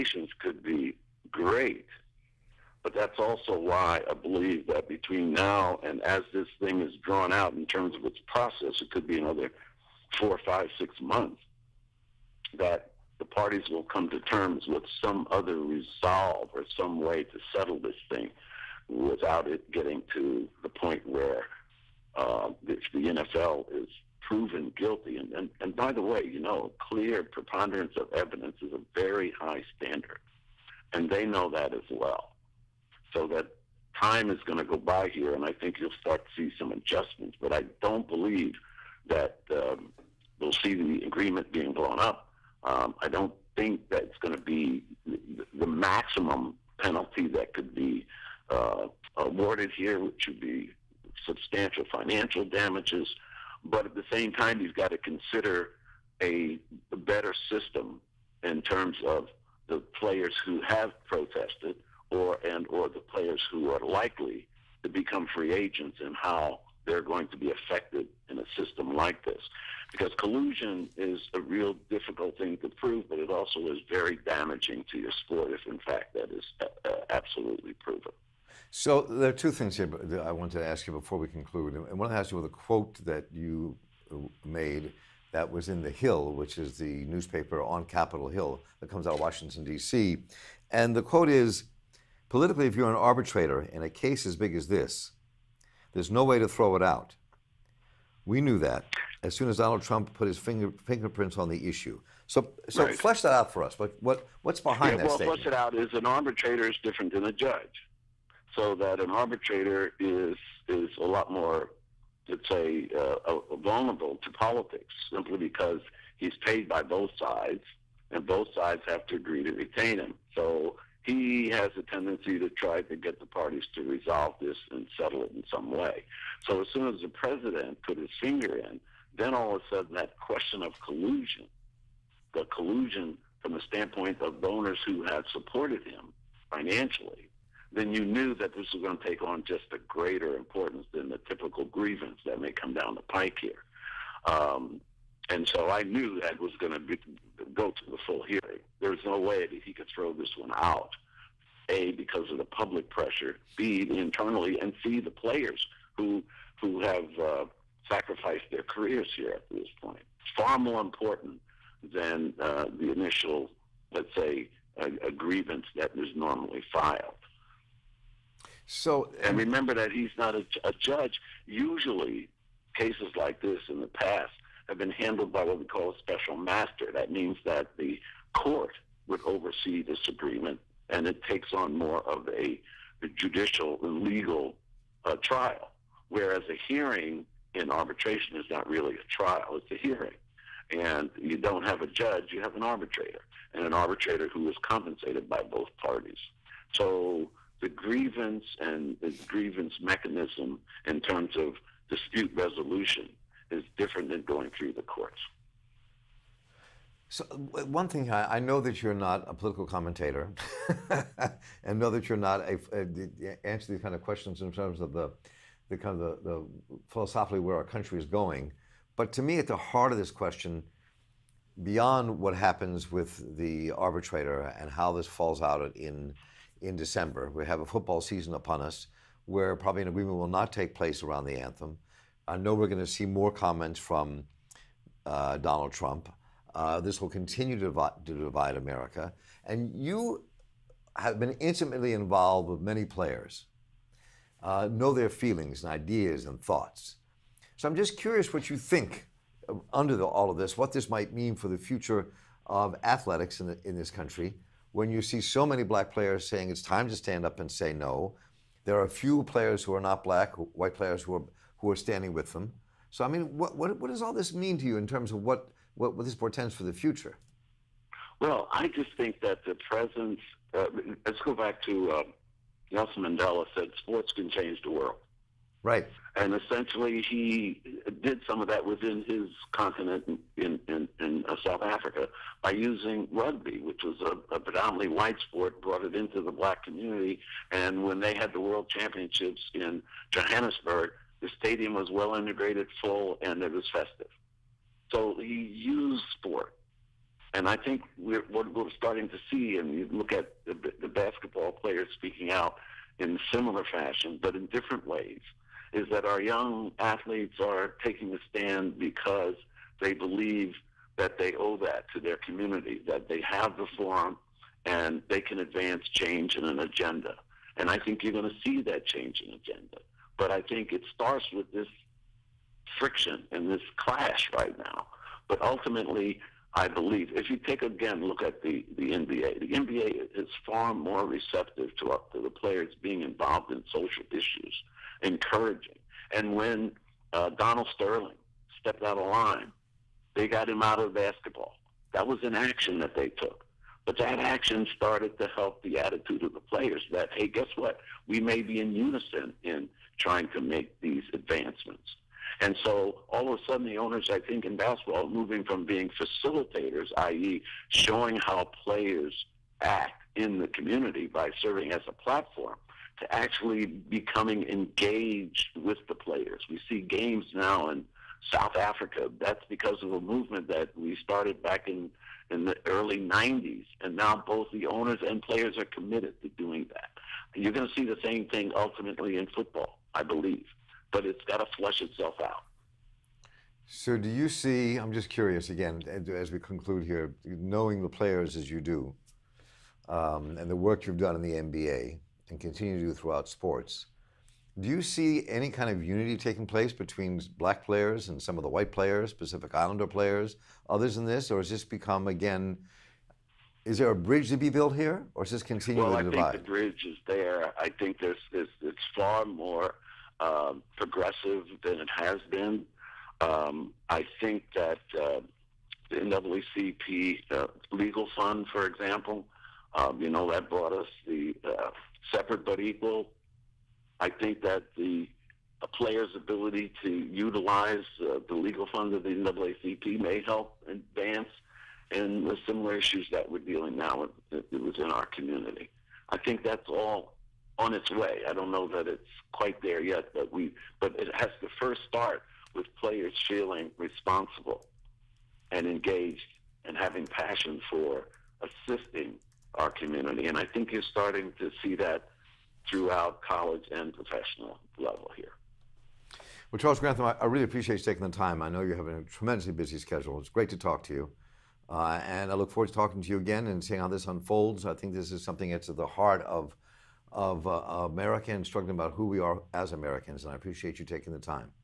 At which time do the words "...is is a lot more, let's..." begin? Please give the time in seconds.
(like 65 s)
109 s.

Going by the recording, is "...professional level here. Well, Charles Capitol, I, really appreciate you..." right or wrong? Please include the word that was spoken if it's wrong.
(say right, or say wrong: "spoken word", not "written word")
wrong: "Grantham", not "Capitol".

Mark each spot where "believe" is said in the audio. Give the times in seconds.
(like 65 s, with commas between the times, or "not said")
4 s, 38 s, 309 s, 326 s, 380 s.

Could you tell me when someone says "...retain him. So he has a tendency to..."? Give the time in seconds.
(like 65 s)
119 s.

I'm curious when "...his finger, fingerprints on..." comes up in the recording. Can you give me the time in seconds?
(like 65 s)
100 s.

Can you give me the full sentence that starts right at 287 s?
And when they had the world championships in Johannesburg, the stadium was well integrated, full, and it was festive.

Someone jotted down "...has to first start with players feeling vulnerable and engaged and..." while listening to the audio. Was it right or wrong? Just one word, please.
wrong.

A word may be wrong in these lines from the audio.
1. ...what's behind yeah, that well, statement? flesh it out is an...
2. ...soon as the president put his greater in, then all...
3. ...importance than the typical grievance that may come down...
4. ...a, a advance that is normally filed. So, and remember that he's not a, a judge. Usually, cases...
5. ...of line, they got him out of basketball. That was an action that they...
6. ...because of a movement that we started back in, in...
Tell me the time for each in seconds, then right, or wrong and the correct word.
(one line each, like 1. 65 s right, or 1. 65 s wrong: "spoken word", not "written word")
1. 104 s right
2. 126 s wrong: "finger", not "greater"
3. 140 s right
4. 164 s wrong: "grievance", not "advance"
5. 338 s right
6. 369 s right.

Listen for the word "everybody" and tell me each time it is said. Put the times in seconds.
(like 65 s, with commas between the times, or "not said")
not said.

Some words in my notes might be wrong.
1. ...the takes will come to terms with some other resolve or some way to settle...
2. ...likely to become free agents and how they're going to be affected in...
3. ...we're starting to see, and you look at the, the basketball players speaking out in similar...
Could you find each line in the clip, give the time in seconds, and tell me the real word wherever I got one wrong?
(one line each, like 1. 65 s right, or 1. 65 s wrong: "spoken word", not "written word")
1. 13 s wrong: "parties", not "takes"
2. 63 s right
3. 298 s right.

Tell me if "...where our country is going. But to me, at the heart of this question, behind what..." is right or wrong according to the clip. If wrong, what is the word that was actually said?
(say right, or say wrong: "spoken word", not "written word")
wrong: "beyond", not "behind".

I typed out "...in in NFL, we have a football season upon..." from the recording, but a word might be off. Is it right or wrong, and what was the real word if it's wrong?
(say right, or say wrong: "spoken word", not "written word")
wrong: "December", not "NFL".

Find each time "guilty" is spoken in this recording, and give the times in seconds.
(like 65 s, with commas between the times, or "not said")
24 s.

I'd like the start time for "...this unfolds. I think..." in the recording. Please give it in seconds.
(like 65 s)
463 s.